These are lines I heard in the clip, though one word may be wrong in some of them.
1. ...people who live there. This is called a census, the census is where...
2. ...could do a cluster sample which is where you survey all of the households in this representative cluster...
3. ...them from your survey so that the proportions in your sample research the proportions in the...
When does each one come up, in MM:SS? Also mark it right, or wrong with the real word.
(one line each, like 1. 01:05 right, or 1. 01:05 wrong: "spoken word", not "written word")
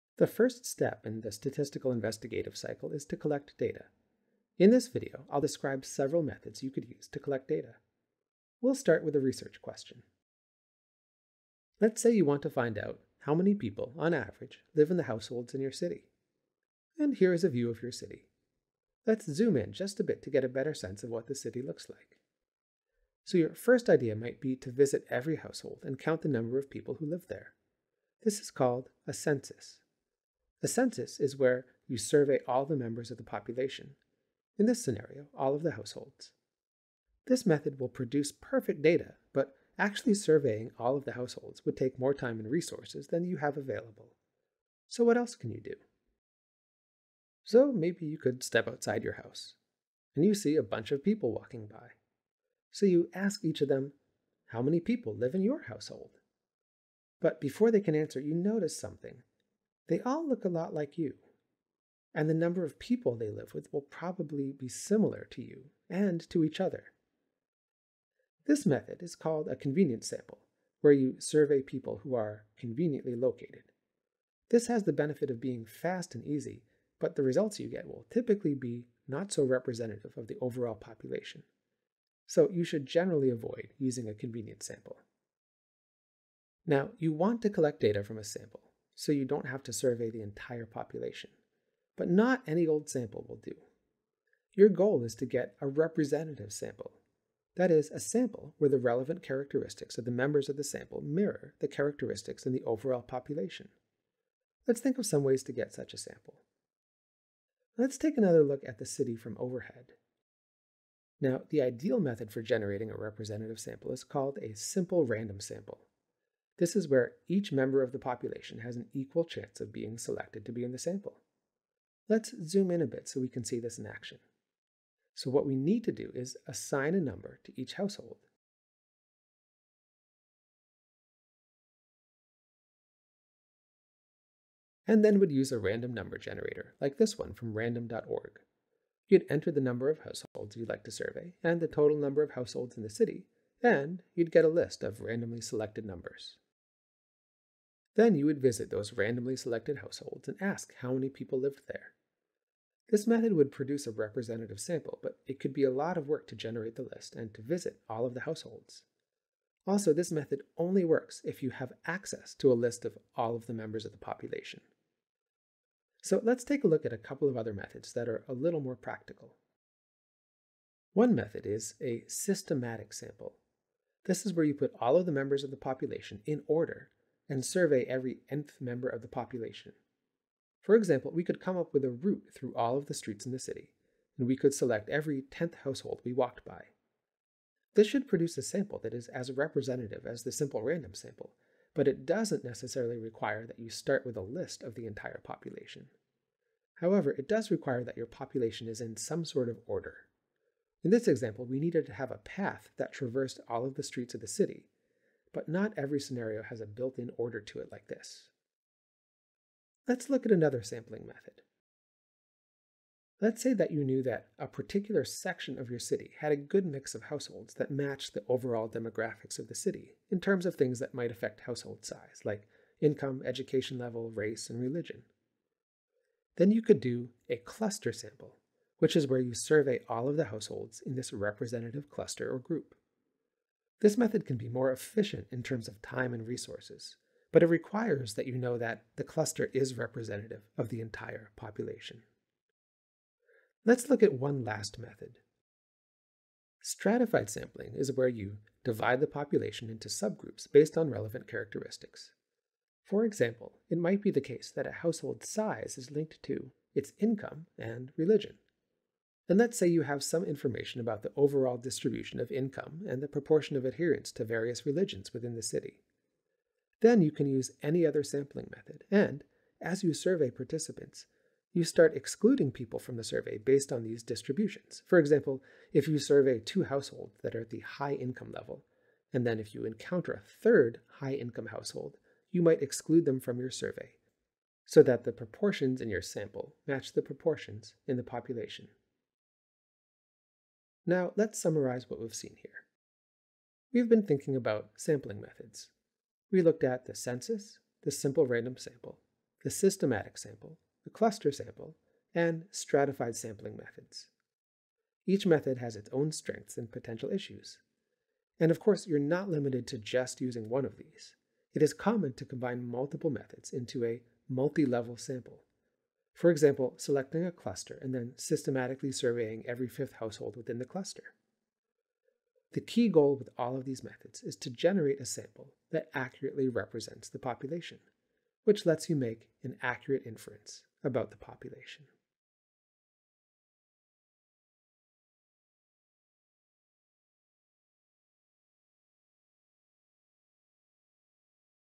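1. 00:26 right
2. 03:46 right
3. 04:43 wrong: "match", not "research".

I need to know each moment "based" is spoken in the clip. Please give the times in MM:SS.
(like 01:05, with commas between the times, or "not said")
04:10, 04:33.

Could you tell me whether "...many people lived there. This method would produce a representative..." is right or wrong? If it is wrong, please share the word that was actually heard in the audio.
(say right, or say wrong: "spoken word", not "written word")
right.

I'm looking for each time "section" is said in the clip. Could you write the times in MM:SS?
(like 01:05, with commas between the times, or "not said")
03:35.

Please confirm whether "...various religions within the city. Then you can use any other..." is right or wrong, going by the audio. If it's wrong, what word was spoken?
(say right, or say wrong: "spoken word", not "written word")
right.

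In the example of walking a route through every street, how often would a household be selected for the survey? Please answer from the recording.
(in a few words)
every 10th household.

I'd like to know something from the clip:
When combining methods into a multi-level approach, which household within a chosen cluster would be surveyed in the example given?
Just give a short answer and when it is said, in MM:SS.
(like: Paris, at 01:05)
every fifth household, at 05:19.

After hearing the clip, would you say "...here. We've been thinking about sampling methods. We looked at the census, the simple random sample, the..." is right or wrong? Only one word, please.
right.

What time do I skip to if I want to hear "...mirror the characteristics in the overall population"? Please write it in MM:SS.
01:41.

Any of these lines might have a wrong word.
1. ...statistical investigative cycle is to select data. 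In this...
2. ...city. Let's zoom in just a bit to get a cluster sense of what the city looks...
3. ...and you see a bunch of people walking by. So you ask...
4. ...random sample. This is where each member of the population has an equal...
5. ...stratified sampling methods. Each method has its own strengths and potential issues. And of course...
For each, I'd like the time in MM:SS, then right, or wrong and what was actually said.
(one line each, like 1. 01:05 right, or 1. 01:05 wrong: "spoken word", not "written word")
1. 00:01 wrong: "collect", not "select"
2. 00:17 wrong: "better", not "cluster"
3. 00:50 right
4. 01:55 right
5. 05:02 right.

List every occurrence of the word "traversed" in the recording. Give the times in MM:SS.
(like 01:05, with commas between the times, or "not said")
03:22.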